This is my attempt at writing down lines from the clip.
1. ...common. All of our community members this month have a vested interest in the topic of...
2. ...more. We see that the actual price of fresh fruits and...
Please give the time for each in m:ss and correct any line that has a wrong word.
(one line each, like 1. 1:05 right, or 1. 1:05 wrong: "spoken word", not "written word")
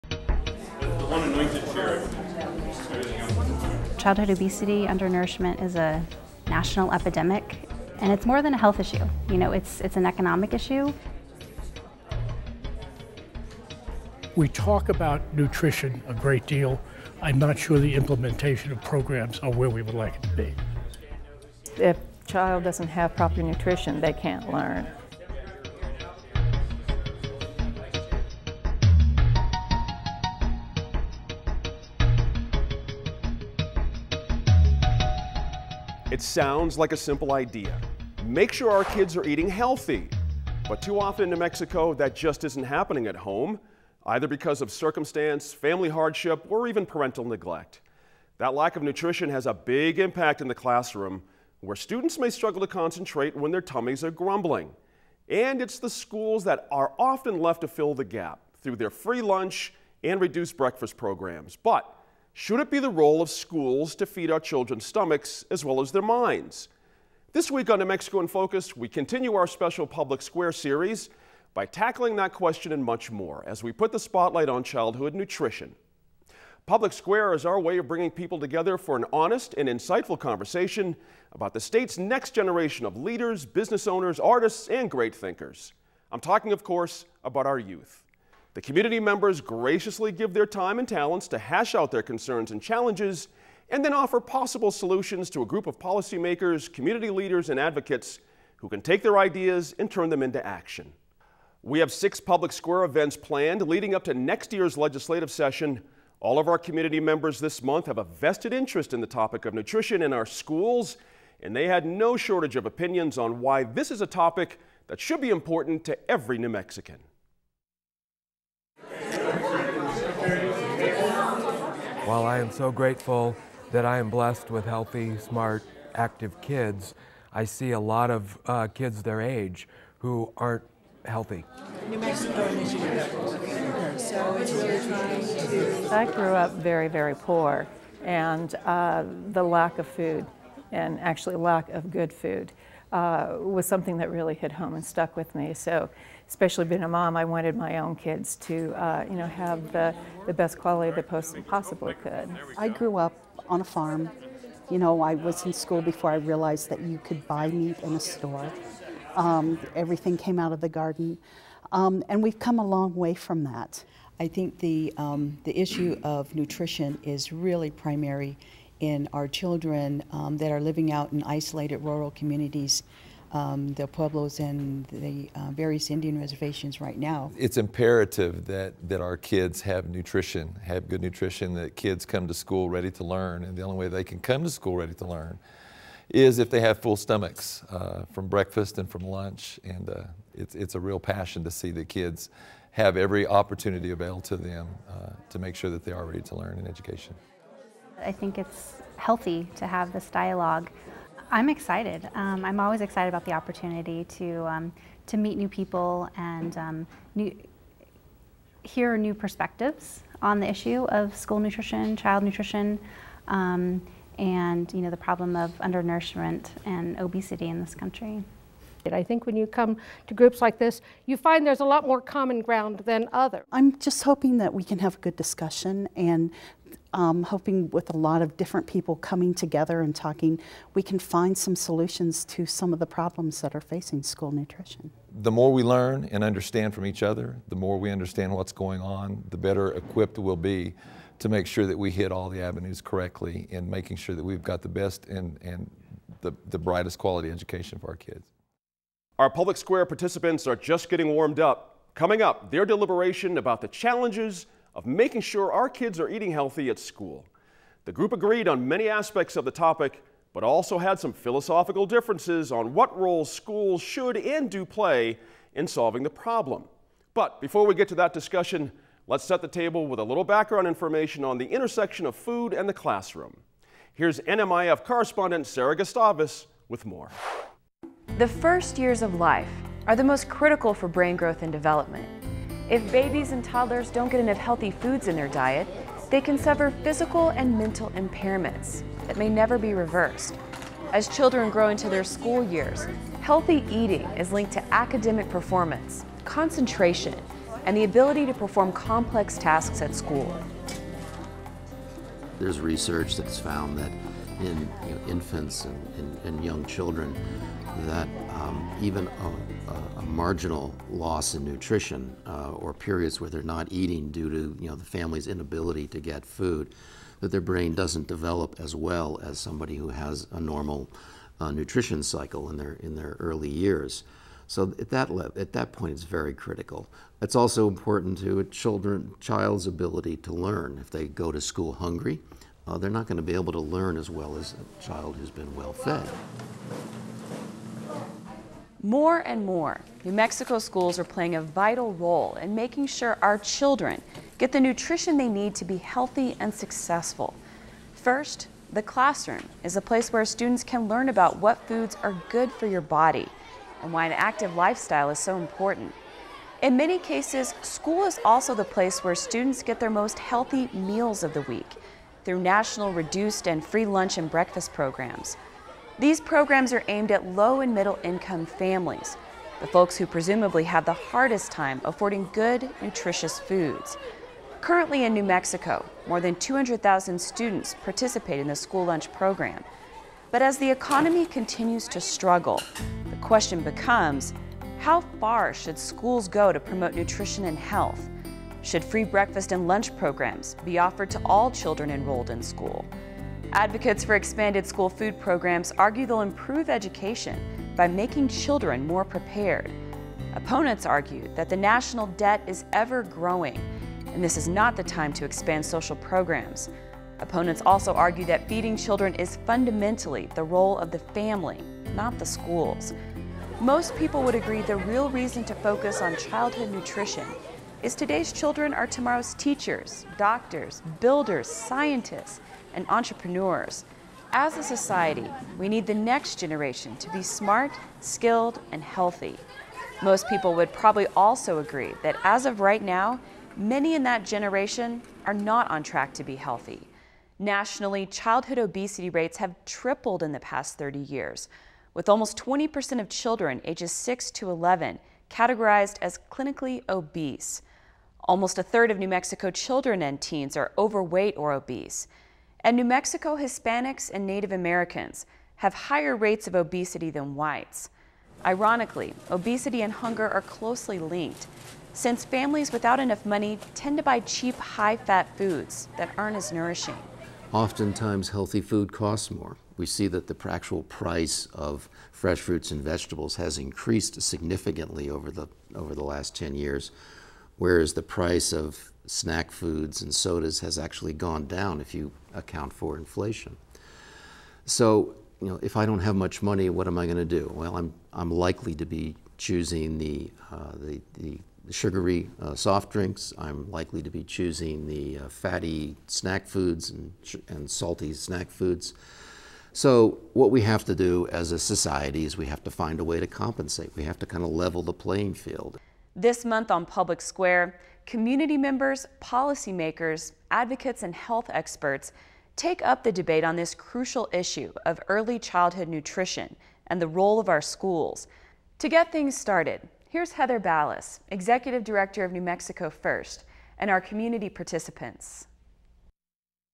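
1. 1:45 wrong: "session", not "common"
2. 7:49 right.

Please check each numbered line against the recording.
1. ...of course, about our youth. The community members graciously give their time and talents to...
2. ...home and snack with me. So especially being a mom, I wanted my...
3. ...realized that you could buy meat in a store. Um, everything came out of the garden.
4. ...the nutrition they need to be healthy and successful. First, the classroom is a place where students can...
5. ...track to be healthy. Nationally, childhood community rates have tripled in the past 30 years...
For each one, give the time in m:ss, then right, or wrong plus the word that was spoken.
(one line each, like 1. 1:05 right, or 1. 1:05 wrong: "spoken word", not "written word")
1. 1:26 right
2. 2:24 wrong: "stuck", not "snack"
3. 2:36 right
4. 5:44 right
5. 7:15 wrong: "obesity", not "community".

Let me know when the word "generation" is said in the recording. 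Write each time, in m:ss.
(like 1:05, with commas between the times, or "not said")
1:22, 7:06, 7:14.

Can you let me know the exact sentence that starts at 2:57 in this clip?
It's imperative that, that our kids have nutrition, have good nutrition, that kids come to school ready to learn.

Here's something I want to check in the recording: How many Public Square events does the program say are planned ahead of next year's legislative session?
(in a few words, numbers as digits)
6.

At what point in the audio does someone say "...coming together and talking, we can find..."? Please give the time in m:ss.
3:48.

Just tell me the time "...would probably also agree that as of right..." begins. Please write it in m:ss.
7:10.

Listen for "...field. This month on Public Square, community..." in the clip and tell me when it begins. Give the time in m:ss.
8:25.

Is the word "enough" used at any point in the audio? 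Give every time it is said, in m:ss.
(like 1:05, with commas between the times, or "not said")
4:44, 7:42.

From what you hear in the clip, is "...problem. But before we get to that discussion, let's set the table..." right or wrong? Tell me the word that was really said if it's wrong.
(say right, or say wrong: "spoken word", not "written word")
right.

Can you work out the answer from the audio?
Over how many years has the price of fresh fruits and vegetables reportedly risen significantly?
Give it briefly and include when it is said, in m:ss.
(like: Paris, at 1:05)
10 years, at 7:56.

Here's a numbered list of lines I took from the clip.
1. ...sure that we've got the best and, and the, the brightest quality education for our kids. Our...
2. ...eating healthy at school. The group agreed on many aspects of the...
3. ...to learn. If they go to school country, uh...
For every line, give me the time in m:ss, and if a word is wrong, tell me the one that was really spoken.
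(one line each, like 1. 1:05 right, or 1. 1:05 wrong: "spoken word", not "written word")
1. 4:03 right
2. 4:16 right
3. 5:30 wrong: "hungry", not "country".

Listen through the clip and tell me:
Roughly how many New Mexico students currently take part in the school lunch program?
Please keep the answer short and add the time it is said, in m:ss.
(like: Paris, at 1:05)
more than 200,000, at 6:16.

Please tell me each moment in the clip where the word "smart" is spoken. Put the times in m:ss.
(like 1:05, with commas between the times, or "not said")
2:05, 7:07.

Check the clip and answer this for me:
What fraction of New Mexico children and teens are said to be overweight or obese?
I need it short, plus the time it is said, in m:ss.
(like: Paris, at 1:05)
almost a third, at 7:28.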